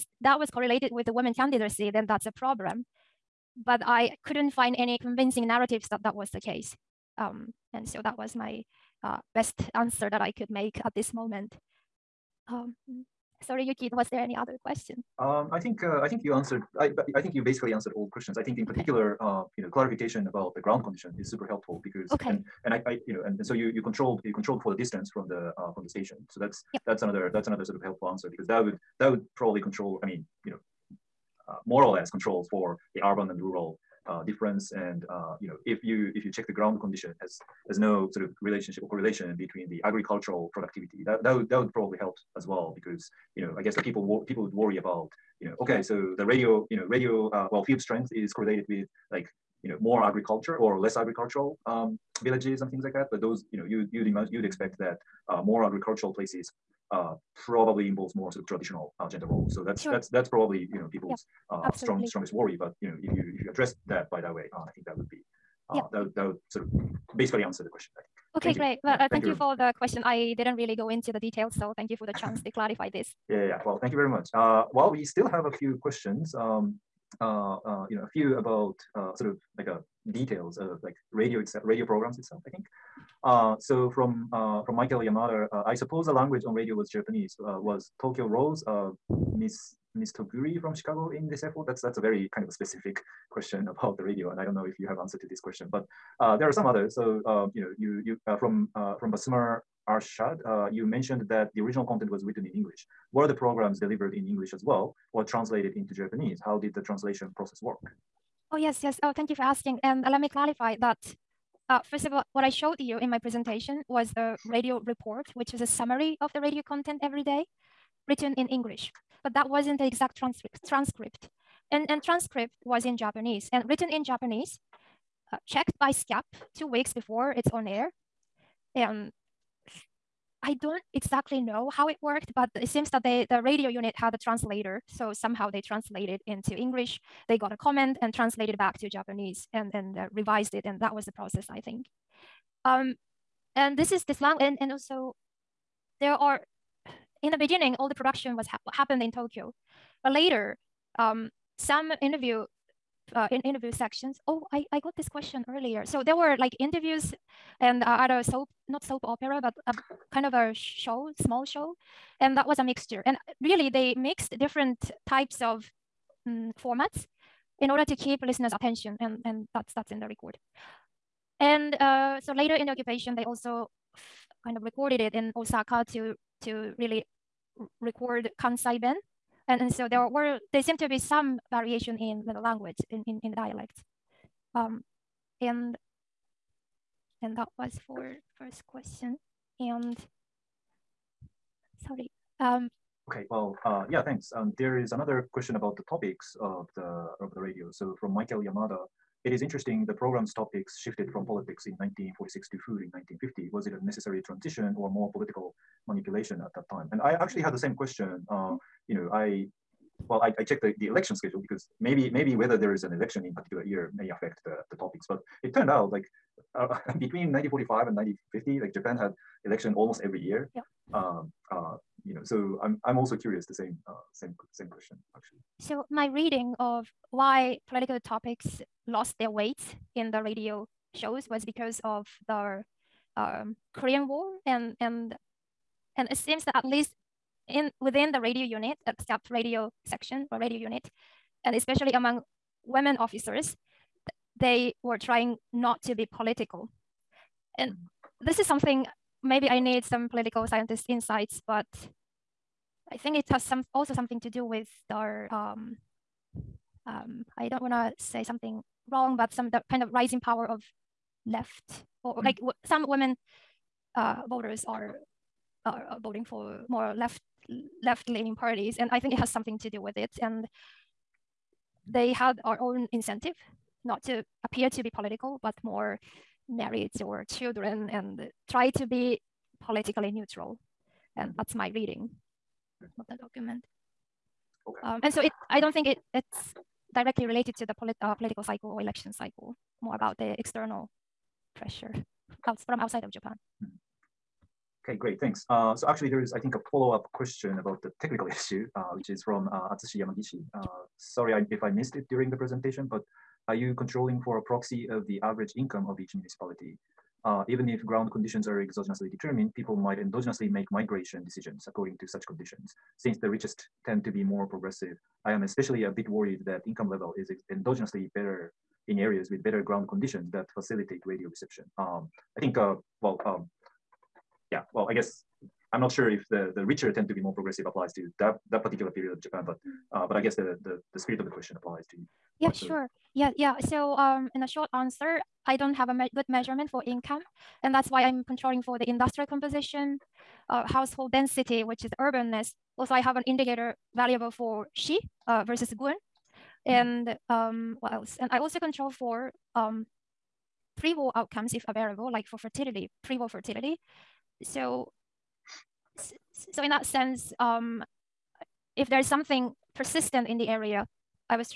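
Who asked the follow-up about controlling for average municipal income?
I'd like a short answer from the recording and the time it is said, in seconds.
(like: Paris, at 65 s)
Atsushi Yamagishi, at 299 s.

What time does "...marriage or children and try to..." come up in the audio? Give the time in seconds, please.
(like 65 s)
276 s.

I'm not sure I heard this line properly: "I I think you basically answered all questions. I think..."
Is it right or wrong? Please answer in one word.
right.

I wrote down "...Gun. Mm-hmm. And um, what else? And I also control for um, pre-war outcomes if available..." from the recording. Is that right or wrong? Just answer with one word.
right.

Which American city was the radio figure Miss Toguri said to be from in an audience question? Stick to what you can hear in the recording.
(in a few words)
Chicago.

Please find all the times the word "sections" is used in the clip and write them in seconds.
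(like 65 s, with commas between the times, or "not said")
153 s, 239 s.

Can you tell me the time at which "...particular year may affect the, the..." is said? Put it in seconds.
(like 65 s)
213 s.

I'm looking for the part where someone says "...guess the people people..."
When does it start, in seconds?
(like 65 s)
43 s.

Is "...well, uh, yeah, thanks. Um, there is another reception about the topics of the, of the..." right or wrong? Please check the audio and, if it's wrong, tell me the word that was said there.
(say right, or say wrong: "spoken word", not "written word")
wrong: "question", not "reception".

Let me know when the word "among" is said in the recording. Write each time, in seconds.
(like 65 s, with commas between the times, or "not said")
241 s.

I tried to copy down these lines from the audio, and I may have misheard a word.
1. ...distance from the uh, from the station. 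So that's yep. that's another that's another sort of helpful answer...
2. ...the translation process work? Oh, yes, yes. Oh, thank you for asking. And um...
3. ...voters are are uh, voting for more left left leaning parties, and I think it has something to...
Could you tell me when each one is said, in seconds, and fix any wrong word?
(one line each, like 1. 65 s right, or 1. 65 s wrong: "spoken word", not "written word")
1. 24 s right
2. 106 s right
3. 264 s right.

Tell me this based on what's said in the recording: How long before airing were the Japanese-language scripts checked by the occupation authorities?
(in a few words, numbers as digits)
2 weeks.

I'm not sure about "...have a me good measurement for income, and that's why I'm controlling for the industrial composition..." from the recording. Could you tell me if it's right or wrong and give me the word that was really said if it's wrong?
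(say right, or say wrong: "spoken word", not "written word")
right.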